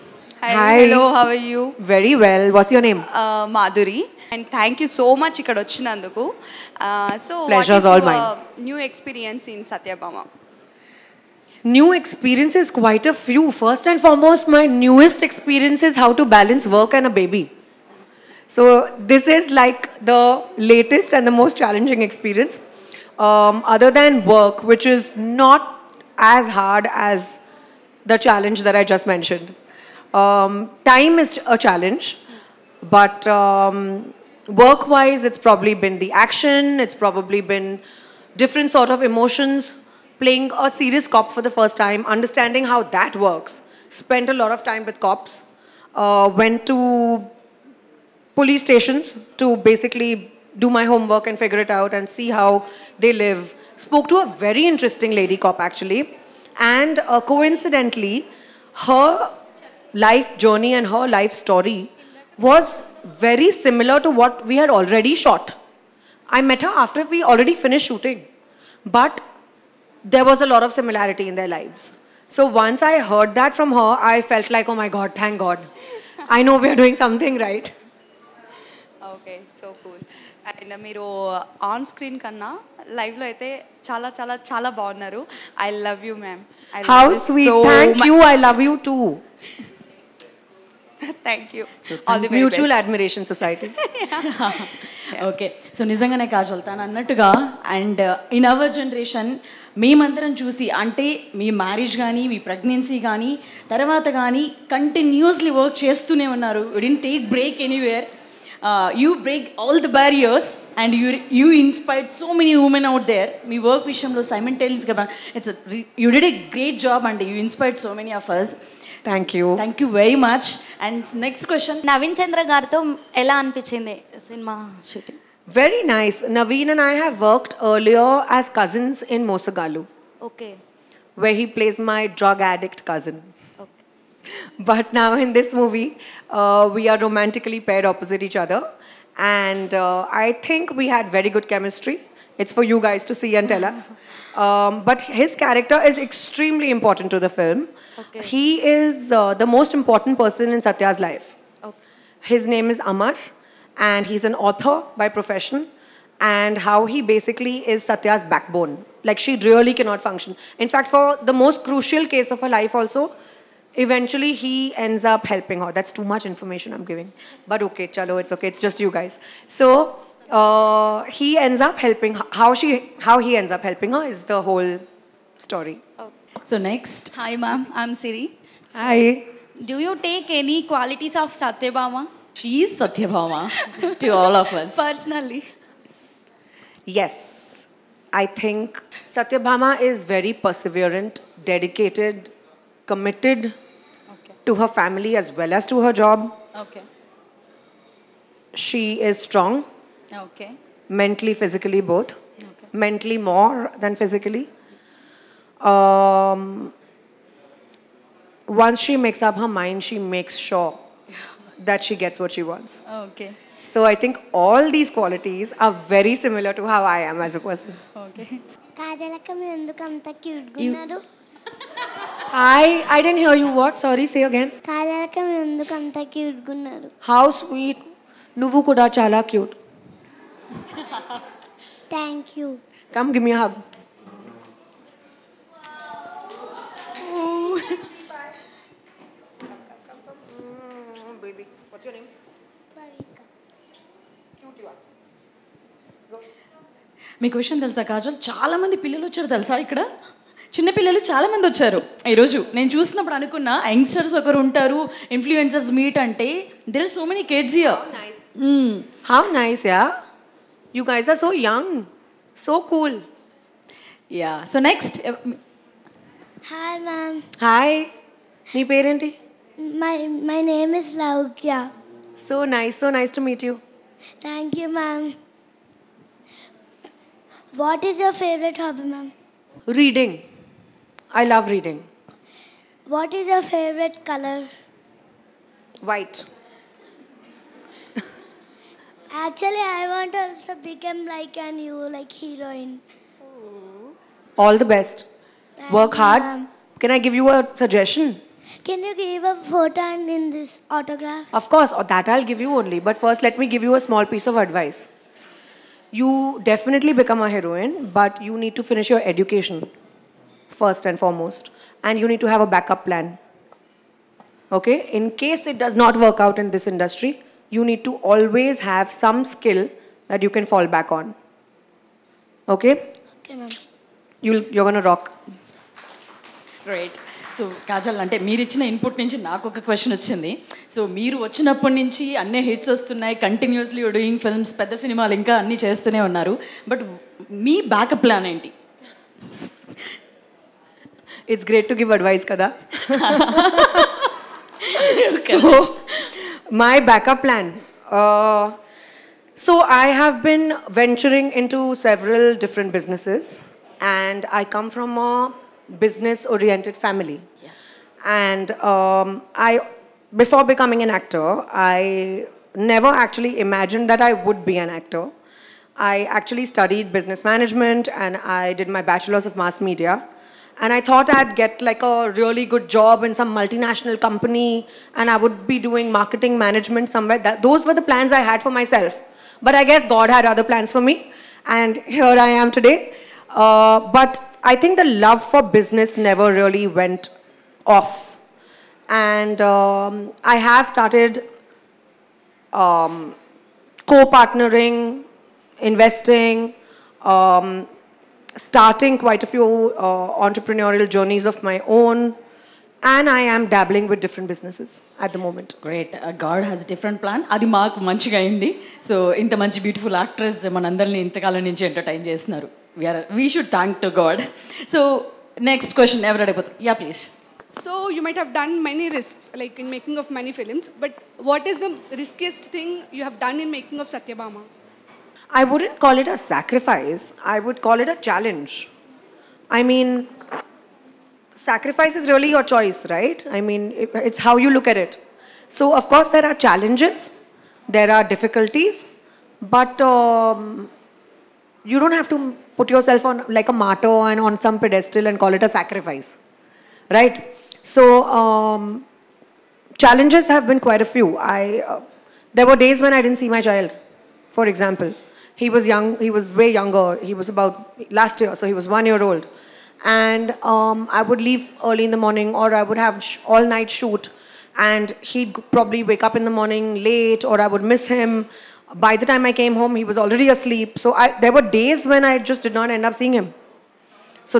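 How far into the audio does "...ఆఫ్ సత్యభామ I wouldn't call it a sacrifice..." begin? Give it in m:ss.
7:03.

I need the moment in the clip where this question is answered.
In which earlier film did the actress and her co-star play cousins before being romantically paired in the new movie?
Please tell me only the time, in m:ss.
2:09.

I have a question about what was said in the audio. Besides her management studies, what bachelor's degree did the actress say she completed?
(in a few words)
Mass media.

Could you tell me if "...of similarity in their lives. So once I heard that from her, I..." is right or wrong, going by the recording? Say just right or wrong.
right.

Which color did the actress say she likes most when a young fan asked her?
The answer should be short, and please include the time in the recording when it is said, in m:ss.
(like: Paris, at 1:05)
White, at 4:45.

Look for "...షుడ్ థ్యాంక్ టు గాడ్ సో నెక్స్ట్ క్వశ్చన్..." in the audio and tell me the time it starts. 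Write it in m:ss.
6:53.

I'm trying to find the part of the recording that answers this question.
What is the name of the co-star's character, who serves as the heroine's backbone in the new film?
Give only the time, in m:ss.
2:32.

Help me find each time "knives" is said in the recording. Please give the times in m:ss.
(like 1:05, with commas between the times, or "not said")
not said.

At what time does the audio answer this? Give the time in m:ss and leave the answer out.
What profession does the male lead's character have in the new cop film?
2:34.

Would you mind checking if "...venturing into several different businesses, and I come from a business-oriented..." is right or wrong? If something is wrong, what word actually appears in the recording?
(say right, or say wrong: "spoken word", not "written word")
right.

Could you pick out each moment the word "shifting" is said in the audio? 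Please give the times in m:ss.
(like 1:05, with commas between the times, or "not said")
not said.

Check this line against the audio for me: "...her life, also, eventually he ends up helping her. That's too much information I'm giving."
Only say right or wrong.
right.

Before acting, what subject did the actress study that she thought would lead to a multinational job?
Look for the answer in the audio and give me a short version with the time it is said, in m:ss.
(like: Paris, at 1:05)
Business management, at 6:06.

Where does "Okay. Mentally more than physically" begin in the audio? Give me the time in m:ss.
3:22.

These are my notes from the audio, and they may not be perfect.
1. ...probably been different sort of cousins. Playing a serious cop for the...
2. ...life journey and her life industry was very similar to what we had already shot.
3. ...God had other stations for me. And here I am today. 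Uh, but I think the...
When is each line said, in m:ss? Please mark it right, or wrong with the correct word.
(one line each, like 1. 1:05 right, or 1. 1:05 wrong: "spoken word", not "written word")
1. 0:36 wrong: "emotions", not "cousins"
2. 0:59 wrong: "story", not "industry"
3. 6:19 wrong: "plans", not "stations".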